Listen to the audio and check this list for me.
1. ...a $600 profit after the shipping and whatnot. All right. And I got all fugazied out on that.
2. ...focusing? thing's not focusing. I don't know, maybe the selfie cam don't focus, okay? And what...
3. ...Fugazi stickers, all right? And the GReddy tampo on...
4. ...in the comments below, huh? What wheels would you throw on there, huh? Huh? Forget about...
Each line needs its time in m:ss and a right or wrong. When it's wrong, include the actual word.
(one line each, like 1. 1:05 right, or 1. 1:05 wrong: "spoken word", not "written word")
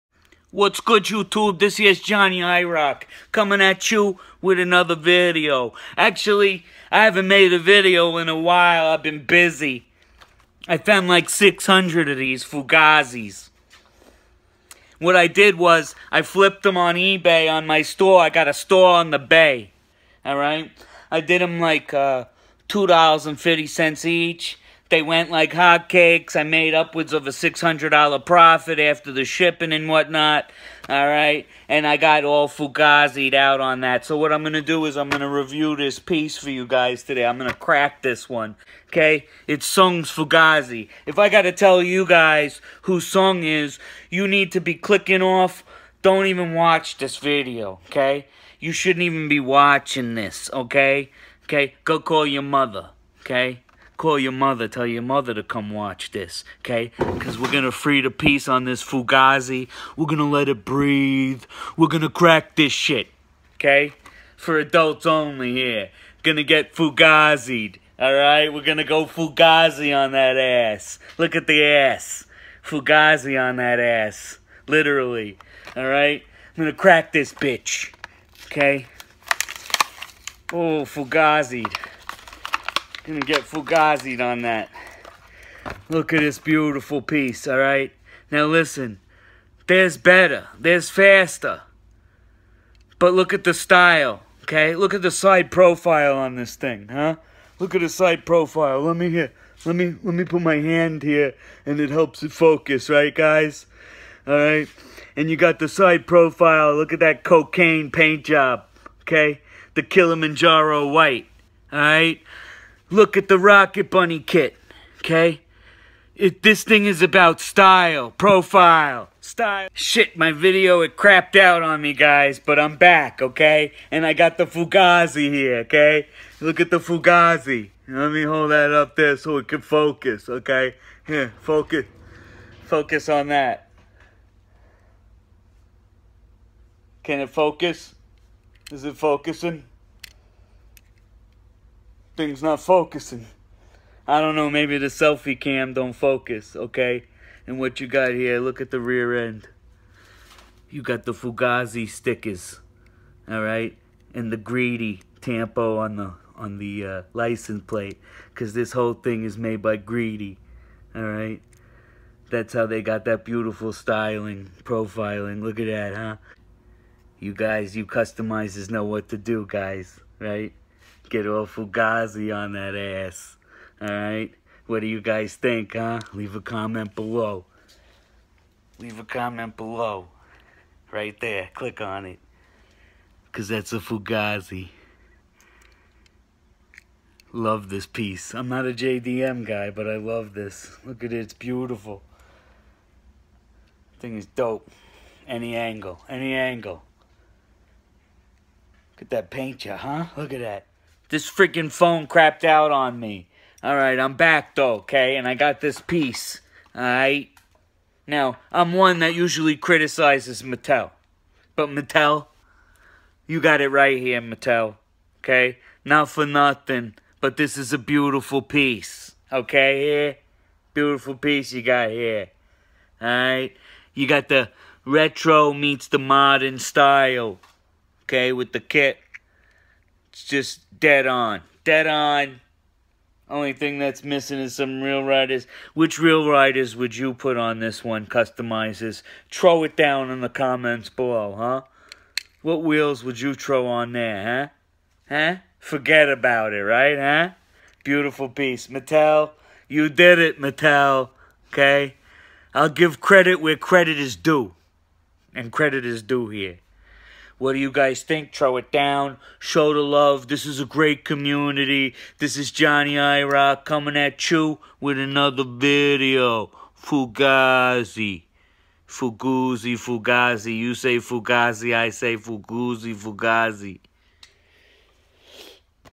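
1. 0:27 right
2. 2:18 right
3. 2:31 right
4. 4:00 right.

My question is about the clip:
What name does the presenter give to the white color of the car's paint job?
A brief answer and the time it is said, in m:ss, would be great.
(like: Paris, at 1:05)
Kilimanjaro white, at 1:49.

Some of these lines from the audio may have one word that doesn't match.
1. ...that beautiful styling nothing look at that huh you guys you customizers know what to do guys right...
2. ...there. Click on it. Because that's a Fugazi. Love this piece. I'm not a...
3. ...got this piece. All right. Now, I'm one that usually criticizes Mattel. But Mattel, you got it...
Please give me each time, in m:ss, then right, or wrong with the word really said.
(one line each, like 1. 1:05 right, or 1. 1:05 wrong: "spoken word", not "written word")
1. 2:43 wrong: "profiling", not "nothing"
2. 3:01 right
3. 3:25 right.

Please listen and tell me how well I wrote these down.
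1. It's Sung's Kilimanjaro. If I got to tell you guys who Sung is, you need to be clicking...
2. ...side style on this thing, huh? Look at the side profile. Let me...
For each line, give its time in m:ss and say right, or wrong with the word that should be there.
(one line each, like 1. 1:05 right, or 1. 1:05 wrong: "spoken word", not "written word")
1. 0:39 wrong: "Fugazi", not "Kilimanjaro"
2. 1:35 wrong: "profile", not "style".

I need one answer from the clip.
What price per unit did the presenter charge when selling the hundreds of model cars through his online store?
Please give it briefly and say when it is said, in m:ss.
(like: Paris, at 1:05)
$2.50, at 0:22.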